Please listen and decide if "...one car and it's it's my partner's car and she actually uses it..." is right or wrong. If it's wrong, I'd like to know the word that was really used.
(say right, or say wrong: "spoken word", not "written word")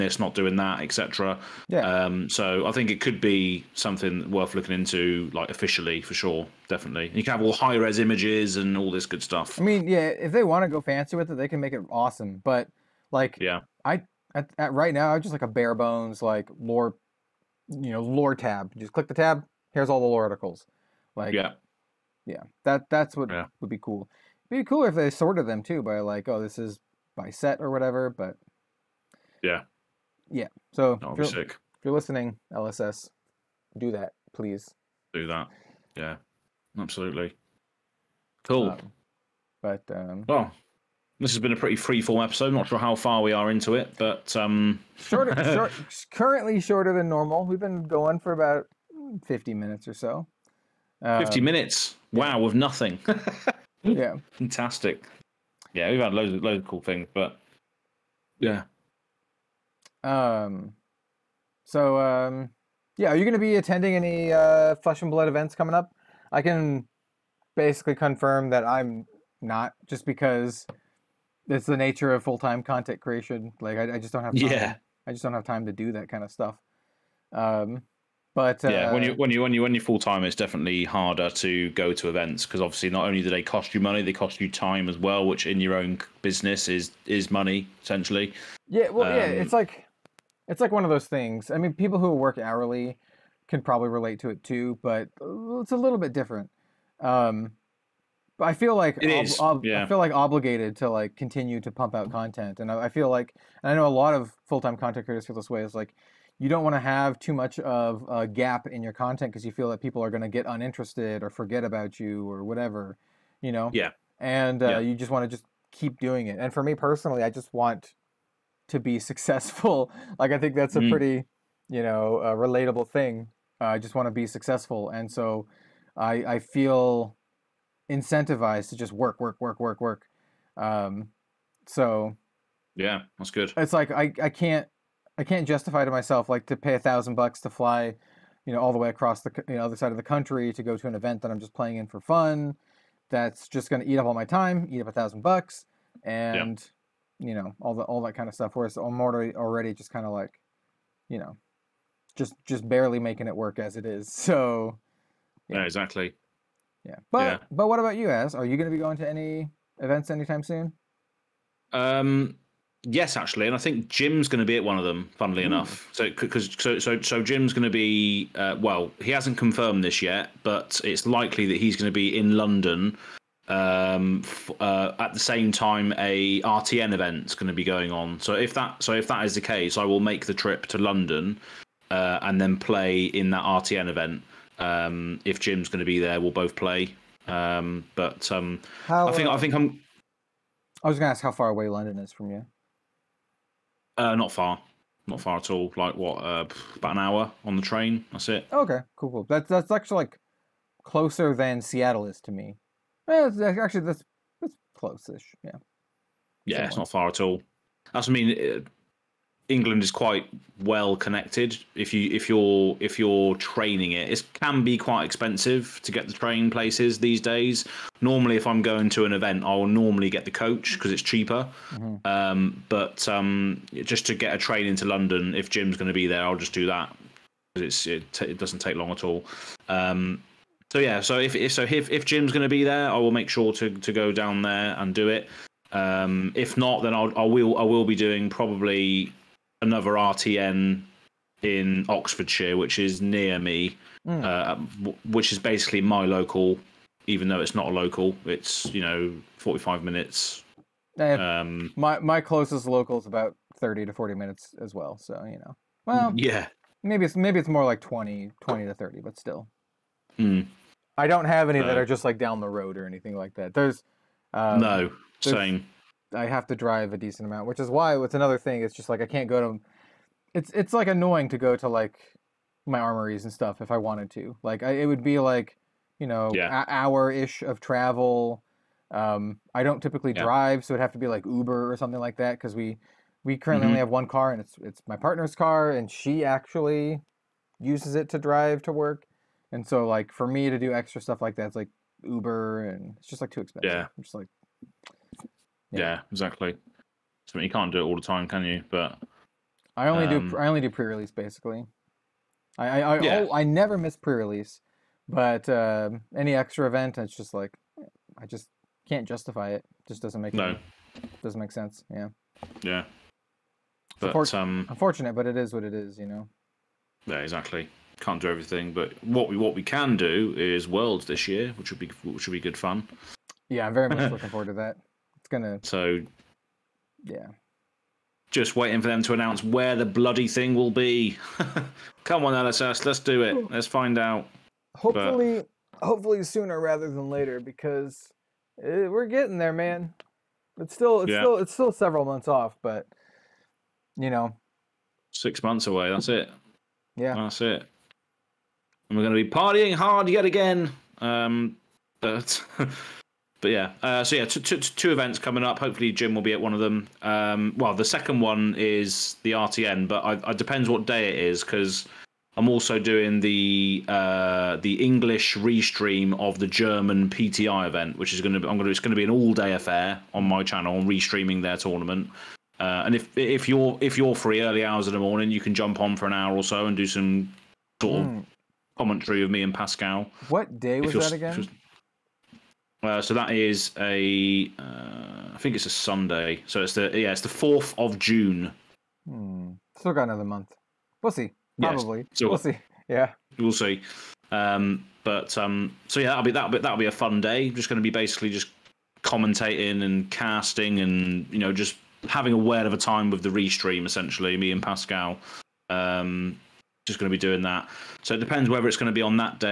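right.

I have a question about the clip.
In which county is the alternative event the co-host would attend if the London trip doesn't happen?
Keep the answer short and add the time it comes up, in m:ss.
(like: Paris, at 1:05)
Oxfordshire, at 4:01.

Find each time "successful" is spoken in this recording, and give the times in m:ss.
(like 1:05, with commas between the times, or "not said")
1:58, 2:04.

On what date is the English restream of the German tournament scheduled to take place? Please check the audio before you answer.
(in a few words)
4 June.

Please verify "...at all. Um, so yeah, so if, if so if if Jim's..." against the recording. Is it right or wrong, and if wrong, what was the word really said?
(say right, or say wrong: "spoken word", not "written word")
right.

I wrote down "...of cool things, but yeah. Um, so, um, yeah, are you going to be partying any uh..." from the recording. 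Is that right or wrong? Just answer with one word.
wrong.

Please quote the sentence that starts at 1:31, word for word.
I mean, people who work hourly can probably relate to it too, but uh, it's a little bit different.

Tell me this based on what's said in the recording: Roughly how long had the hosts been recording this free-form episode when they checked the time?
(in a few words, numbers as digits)
50 minutes.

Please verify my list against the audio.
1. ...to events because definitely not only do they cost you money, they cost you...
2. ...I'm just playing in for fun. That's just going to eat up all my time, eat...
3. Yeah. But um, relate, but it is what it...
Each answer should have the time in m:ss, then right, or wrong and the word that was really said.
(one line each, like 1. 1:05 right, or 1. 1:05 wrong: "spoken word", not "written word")
1. 1:21 wrong: "obviously", not "definitely"
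2. 2:21 right
3. 5:12 wrong: "unfortunate", not "relate".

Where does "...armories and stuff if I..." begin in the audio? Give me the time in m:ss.
4:32.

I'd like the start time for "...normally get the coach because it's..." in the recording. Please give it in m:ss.
3:39.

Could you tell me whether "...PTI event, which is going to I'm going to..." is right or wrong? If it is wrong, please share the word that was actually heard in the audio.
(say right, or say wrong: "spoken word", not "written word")
right.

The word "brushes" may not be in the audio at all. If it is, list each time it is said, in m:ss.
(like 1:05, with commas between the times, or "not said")
not said.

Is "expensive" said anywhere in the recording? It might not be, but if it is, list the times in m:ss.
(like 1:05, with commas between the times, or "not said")
3:35, 4:53.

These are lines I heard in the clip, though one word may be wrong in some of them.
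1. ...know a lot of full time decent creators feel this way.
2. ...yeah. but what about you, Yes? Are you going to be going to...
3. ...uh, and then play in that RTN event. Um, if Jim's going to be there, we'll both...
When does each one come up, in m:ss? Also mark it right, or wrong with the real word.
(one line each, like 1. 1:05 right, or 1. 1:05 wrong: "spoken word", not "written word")
1. 1:43 wrong: "content", not "decent"
2. 2:37 wrong: "Azz", not "Yes"
3. 3:01 right.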